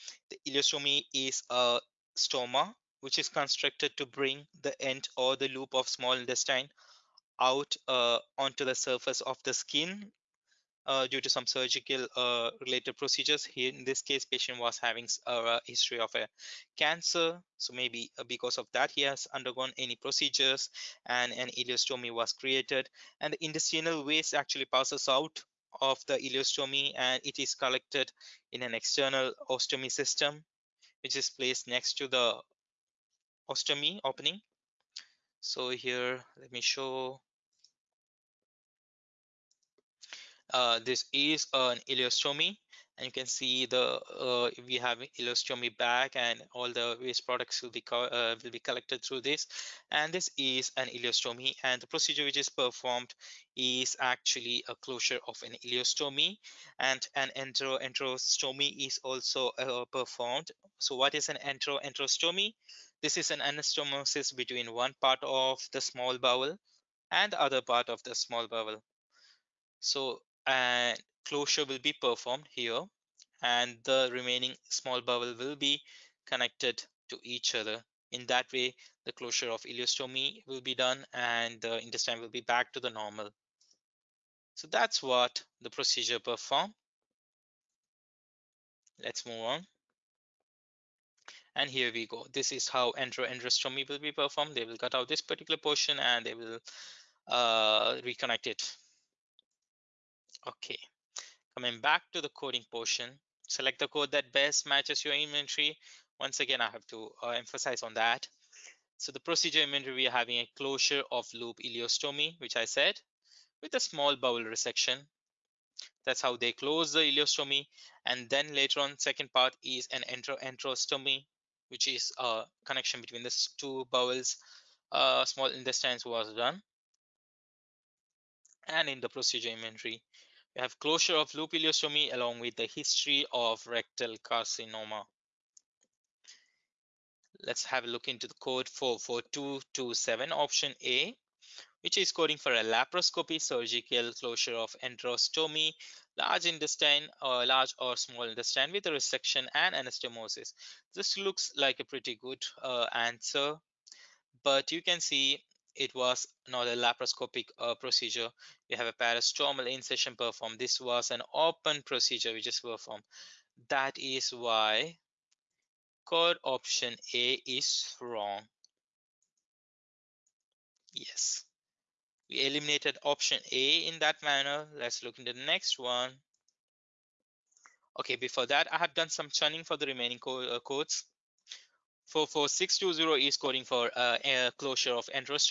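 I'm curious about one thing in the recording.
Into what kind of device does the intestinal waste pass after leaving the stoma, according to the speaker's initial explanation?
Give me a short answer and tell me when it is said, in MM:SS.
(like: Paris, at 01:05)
external ostomy system, at 00:28.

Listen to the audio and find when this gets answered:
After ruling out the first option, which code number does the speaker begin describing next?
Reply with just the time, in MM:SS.
03:02.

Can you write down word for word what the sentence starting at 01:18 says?
In that way, the closure of ileostomy will be done and the intestine will be back to the normal.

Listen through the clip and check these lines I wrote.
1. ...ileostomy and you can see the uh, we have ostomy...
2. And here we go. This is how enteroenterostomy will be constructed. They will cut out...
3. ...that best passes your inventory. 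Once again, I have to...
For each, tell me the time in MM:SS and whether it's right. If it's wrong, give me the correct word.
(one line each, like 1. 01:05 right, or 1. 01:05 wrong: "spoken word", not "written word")
1. 00:41 wrong: "ileostomy", not "ostomy"
2. 01:31 wrong: "performed", not "constructed"
3. 01:44 wrong: "matches", not "passes".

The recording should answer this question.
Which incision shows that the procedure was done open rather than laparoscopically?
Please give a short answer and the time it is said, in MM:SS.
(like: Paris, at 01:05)
parastomal incision, at 02:38.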